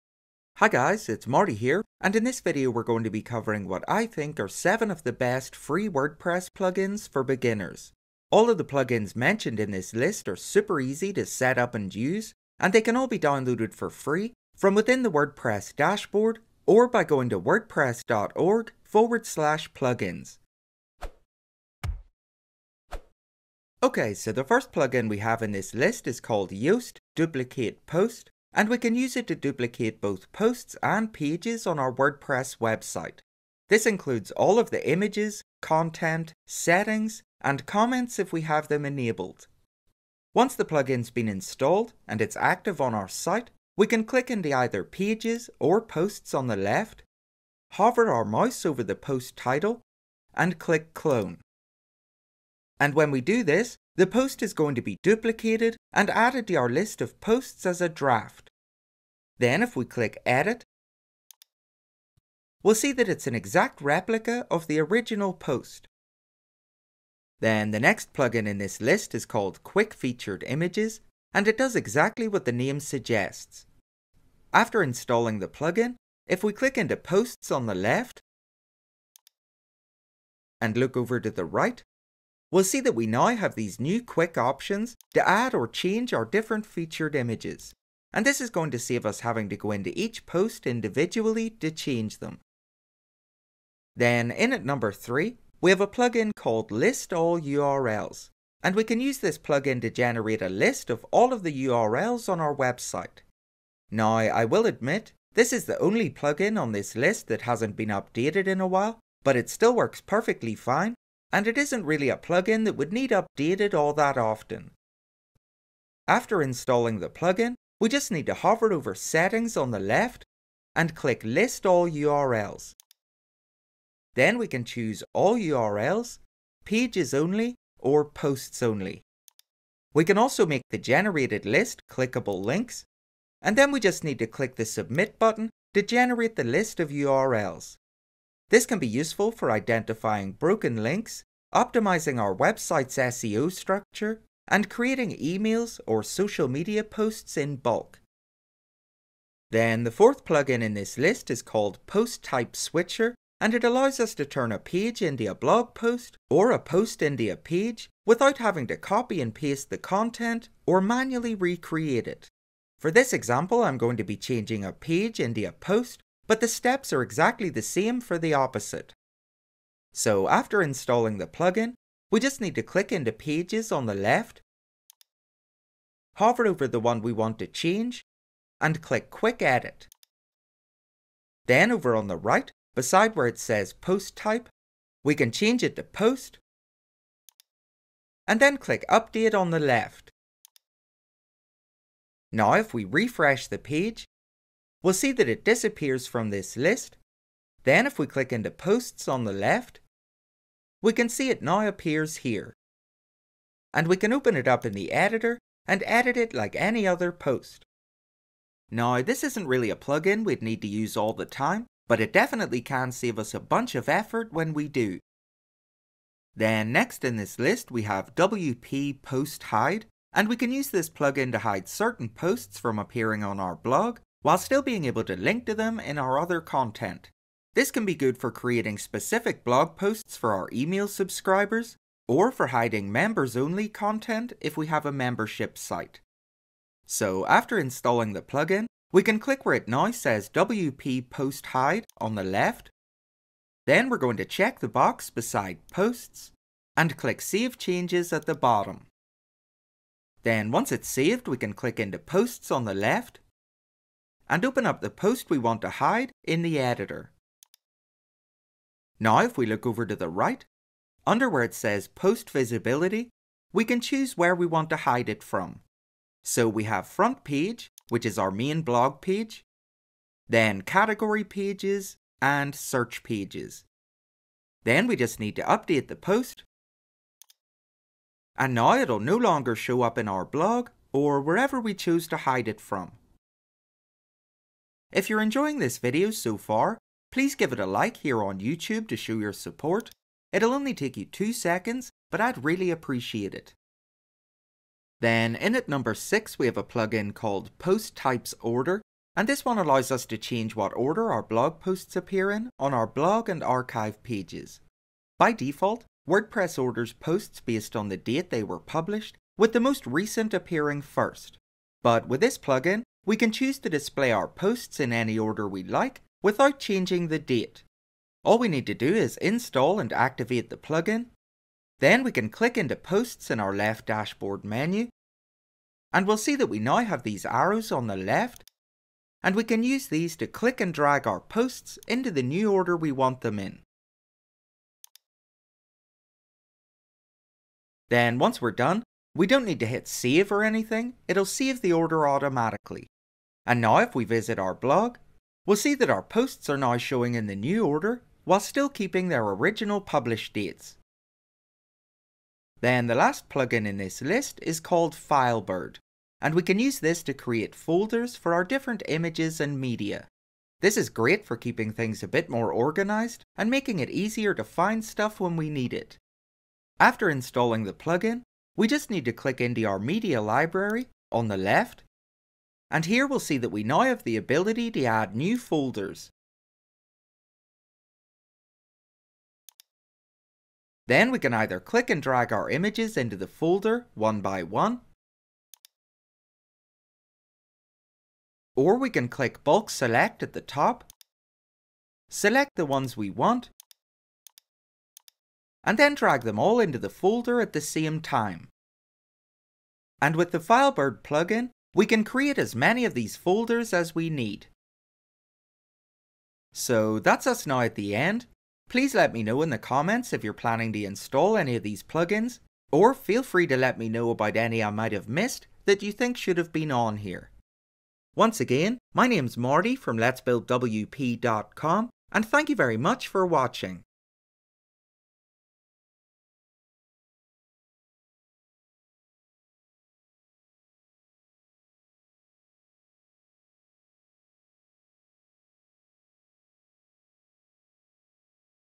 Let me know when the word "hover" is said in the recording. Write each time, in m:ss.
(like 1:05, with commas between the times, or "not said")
0:47, 1:58, 2:56.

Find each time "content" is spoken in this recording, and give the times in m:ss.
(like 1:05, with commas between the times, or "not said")
0:35, 2:39, 3:46, 3:53.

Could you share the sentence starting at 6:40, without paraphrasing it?
And with the Filebird plugin, we can create as many of these folders as we need.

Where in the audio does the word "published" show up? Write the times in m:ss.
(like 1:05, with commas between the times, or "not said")
5:08, 5:49.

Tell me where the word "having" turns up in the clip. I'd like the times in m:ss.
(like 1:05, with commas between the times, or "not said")
1:29, 2:38.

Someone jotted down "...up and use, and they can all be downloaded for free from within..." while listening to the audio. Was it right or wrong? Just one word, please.
right.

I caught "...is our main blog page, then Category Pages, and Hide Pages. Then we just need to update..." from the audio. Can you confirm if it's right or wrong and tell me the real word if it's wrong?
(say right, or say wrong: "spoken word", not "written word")
wrong: "Search", not "Hide".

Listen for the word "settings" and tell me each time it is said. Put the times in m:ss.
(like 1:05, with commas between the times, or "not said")
0:36, 1:58.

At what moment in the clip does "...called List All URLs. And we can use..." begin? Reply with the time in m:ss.
1:36.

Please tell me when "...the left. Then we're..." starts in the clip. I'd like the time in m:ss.
4:02.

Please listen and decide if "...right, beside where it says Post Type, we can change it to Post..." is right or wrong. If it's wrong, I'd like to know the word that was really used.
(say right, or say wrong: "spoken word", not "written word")
right.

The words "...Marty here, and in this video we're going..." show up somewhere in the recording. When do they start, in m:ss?
0:01.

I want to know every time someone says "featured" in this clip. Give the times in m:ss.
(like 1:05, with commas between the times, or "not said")
1:09, 1:26.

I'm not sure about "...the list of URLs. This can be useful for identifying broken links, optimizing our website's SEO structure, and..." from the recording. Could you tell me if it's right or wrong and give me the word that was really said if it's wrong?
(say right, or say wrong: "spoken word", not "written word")
right.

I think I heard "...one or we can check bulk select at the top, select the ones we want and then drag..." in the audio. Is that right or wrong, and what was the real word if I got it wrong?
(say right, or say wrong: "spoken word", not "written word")
wrong: "click", not "check".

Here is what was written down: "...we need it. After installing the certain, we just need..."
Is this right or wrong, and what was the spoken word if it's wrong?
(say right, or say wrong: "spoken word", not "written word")
wrong: "plugin", not "certain".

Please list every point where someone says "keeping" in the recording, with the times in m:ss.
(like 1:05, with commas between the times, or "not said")
5:48, 6:01.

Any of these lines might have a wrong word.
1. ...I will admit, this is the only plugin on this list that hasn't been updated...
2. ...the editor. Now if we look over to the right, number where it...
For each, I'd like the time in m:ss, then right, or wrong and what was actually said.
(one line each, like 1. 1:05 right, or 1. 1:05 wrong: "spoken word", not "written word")
1. 1:44 right
2. 4:16 wrong: "under", not "number".